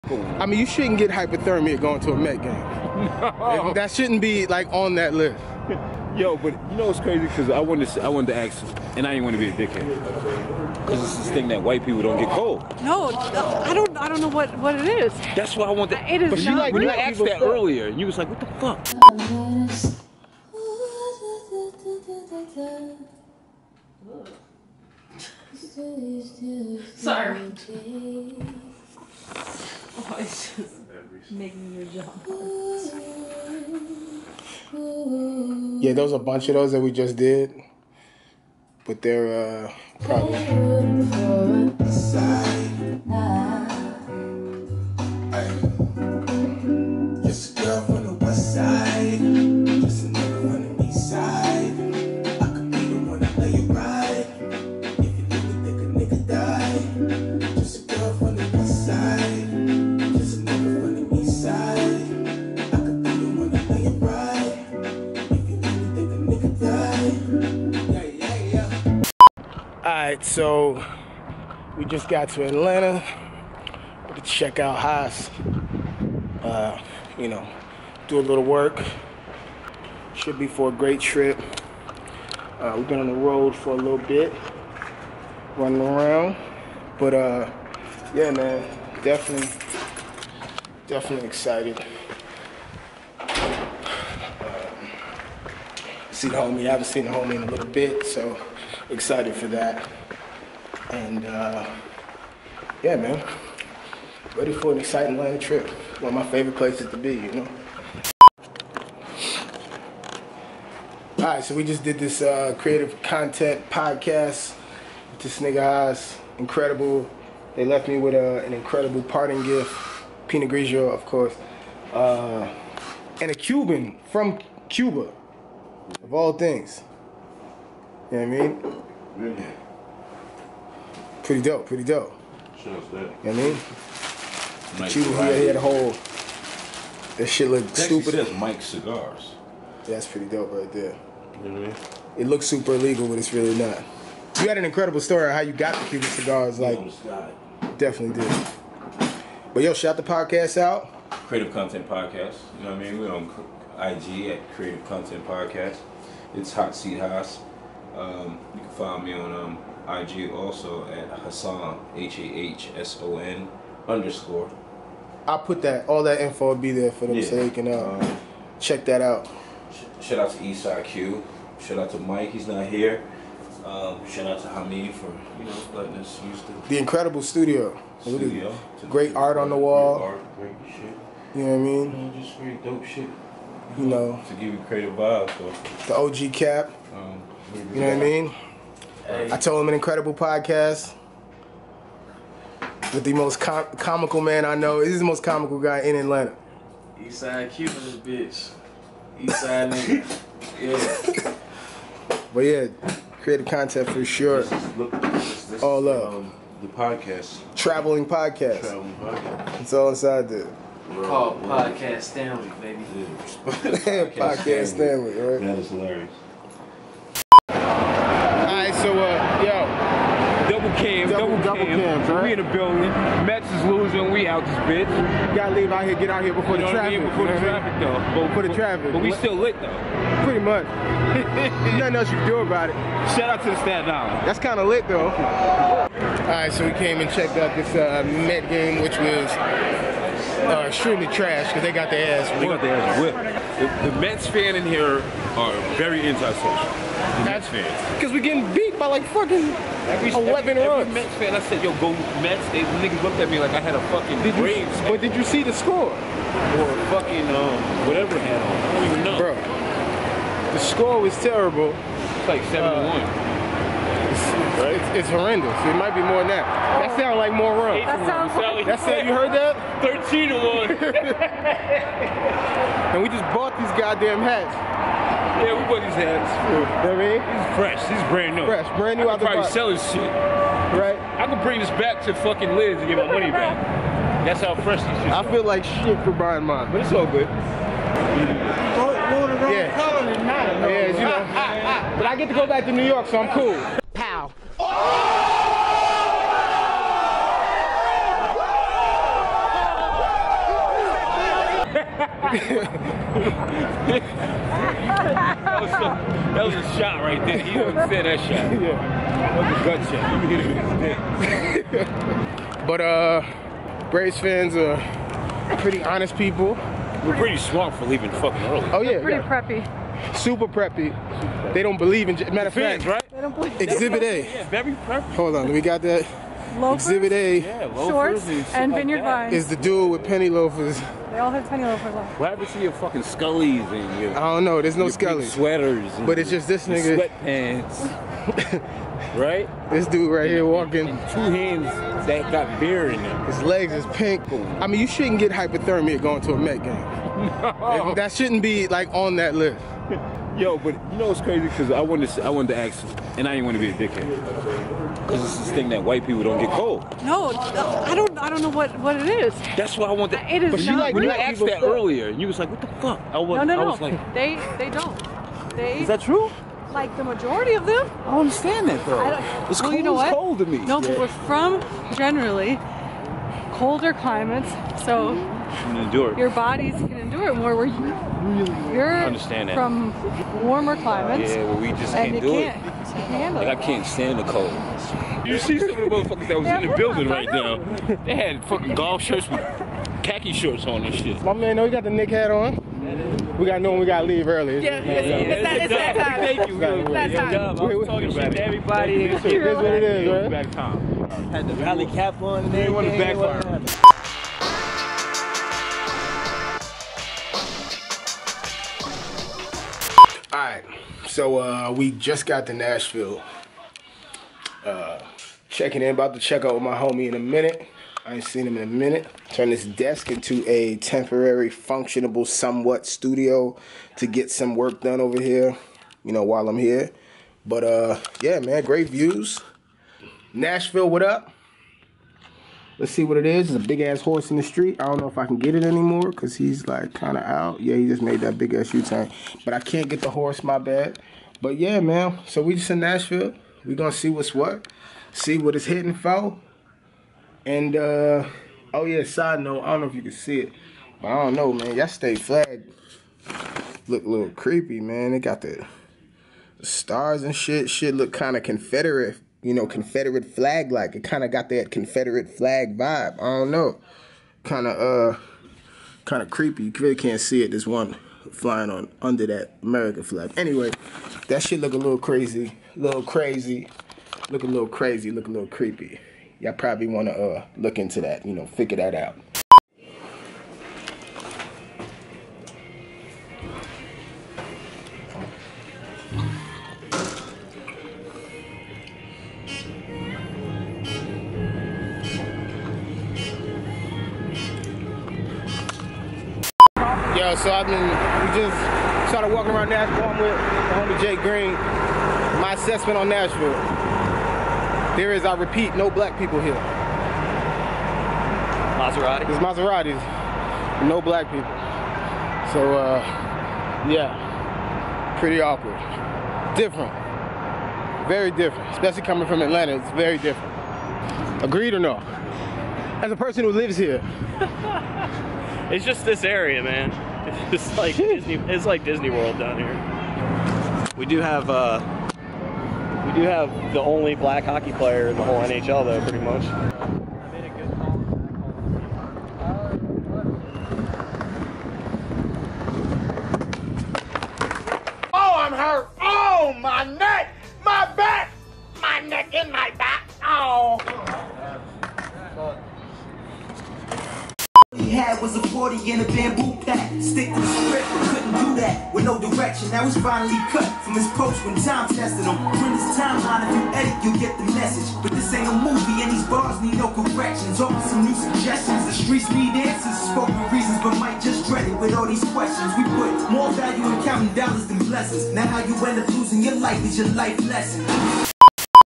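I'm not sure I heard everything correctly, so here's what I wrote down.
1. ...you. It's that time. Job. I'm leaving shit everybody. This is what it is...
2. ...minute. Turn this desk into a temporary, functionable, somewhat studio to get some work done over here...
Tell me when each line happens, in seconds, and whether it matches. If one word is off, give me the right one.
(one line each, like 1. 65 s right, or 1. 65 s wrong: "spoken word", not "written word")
1. 396 s wrong: "talking", not "leaving"
2. 418 s right.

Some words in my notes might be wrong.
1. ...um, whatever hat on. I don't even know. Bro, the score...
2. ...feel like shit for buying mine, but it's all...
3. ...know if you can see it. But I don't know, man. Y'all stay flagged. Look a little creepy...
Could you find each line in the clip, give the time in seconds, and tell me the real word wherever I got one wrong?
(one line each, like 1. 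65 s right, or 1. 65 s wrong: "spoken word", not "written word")
1. 257 s right
2. 285 s right
3. 449 s right.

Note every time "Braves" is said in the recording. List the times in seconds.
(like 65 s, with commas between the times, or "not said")
254 s, 313 s.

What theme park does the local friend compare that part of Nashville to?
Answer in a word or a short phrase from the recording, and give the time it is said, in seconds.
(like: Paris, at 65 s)
Disney World, at 528 s.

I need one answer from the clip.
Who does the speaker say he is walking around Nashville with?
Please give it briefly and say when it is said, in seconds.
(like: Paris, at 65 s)
Jay Green, at 501 s.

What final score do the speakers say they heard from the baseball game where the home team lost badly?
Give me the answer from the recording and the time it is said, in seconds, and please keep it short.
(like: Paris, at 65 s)
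13 to 1, at 270 s.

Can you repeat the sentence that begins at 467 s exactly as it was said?
There's one flying on under that American flag.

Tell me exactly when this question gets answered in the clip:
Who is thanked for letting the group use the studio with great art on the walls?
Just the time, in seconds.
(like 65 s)
174 s.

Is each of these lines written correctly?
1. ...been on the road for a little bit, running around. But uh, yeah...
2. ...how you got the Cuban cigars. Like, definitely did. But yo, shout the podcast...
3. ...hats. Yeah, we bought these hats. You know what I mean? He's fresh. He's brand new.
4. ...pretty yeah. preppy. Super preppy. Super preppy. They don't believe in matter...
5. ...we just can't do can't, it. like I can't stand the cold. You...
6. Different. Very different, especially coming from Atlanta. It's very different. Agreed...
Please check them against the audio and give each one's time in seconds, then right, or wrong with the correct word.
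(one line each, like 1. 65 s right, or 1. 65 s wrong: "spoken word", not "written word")
1. 82 s right
2. 145 s right
3. 274 s right
4. 319 s right
5. 381 s right
6. 516 s right.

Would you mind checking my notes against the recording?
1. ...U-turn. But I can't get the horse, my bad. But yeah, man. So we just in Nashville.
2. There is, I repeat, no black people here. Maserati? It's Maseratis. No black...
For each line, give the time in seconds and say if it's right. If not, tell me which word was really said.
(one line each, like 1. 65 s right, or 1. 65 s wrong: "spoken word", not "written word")
1. 438 s right
2. 504 s right.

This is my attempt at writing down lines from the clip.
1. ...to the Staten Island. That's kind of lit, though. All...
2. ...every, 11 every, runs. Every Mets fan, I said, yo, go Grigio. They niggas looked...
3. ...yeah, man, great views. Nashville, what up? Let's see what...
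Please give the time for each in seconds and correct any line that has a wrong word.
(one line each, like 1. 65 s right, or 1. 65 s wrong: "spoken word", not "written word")
1. 233 s right
2. 249 s wrong: "Mets", not "Grigio"
3. 428 s right.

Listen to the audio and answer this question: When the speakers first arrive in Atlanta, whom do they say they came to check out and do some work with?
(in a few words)
Haas.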